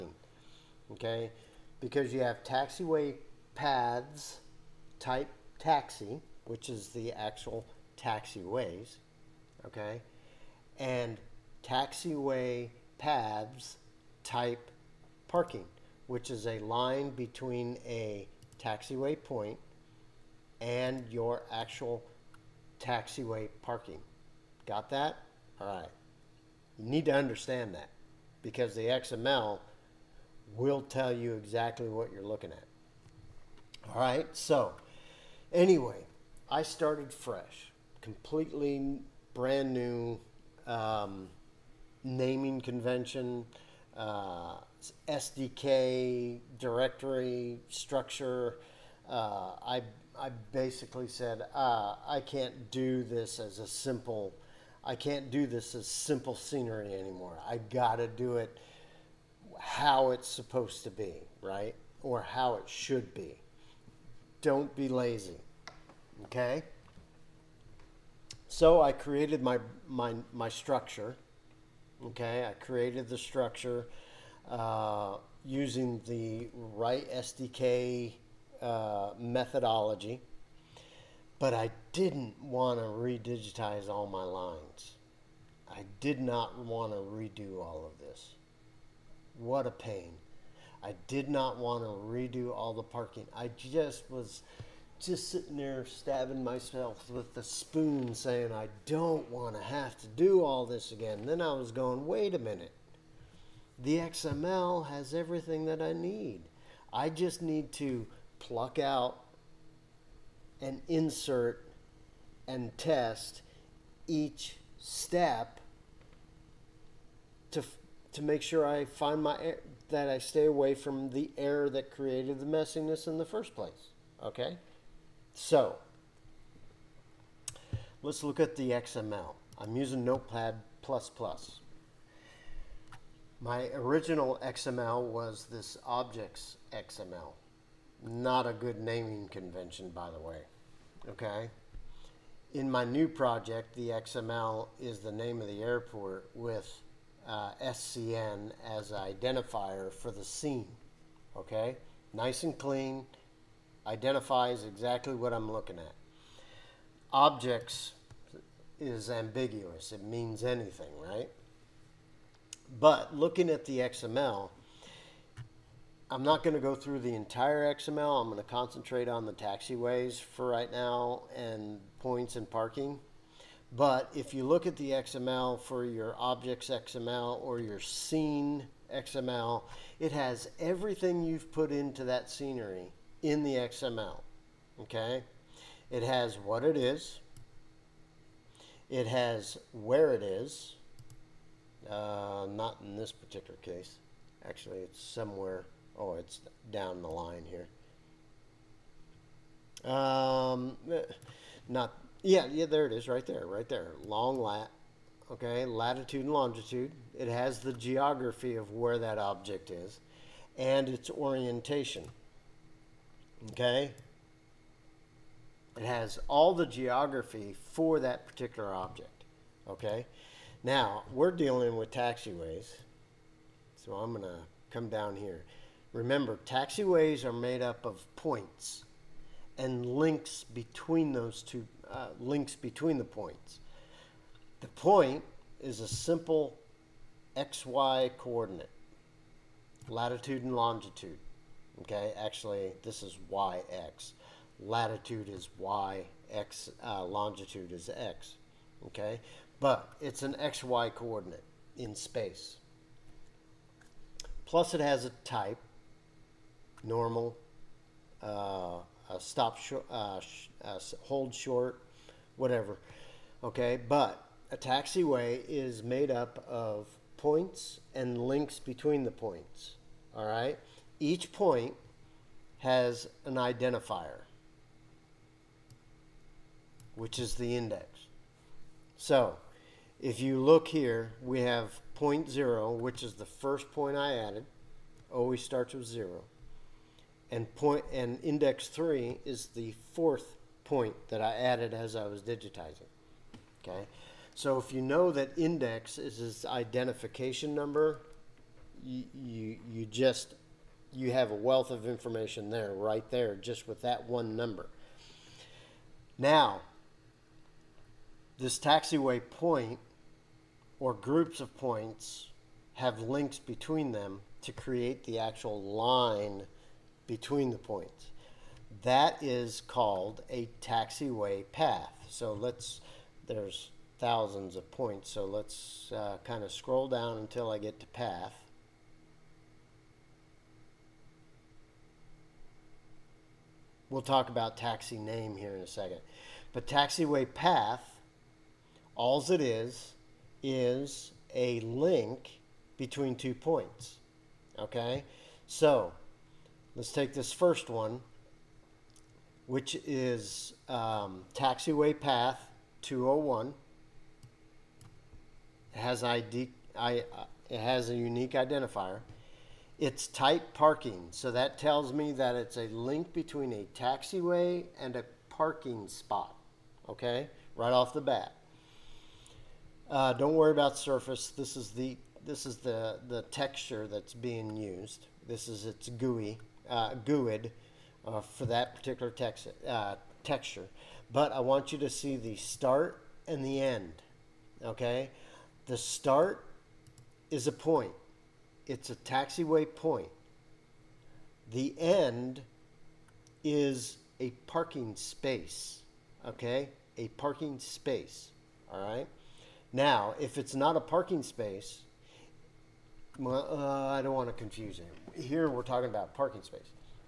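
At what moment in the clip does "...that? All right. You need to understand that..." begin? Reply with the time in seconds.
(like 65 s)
24 s.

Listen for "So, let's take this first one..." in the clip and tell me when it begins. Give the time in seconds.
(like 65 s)
345 s.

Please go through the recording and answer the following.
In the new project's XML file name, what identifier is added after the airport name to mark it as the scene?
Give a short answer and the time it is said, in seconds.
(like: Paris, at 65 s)
SCN, at 147 s.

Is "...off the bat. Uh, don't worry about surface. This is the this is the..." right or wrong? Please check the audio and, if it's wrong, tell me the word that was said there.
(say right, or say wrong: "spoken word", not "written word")
right.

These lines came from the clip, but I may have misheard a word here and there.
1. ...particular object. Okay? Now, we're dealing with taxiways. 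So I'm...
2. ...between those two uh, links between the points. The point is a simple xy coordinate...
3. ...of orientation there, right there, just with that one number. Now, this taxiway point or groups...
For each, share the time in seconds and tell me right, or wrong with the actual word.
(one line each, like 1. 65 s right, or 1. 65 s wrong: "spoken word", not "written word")
1. 218 s right
2. 230 s right
3. 301 s wrong: "information", not "orientation".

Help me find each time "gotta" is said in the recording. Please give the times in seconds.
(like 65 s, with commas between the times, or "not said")
57 s.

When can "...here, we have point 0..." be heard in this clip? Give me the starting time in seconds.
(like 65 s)
280 s.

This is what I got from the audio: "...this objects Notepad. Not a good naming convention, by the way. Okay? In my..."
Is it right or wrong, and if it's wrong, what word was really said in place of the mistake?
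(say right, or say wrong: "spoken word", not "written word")
wrong: "XML", not "Notepad".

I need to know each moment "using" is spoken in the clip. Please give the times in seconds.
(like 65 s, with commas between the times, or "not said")
75 s, 129 s.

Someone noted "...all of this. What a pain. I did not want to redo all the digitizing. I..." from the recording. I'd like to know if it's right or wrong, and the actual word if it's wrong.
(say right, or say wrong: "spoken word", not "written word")
wrong: "parking", not "digitizing".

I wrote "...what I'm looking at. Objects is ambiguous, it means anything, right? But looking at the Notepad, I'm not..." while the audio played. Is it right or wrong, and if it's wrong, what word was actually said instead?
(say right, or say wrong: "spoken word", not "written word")
wrong: "XML", not "Notepad".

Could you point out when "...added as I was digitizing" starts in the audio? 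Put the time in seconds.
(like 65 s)
291 s.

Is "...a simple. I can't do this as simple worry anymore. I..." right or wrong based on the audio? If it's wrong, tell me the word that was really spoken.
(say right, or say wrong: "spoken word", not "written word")
wrong: "scenery", not "worry".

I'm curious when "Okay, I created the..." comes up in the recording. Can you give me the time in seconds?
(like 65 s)
72 s.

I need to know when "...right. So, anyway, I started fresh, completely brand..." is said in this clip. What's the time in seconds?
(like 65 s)
33 s.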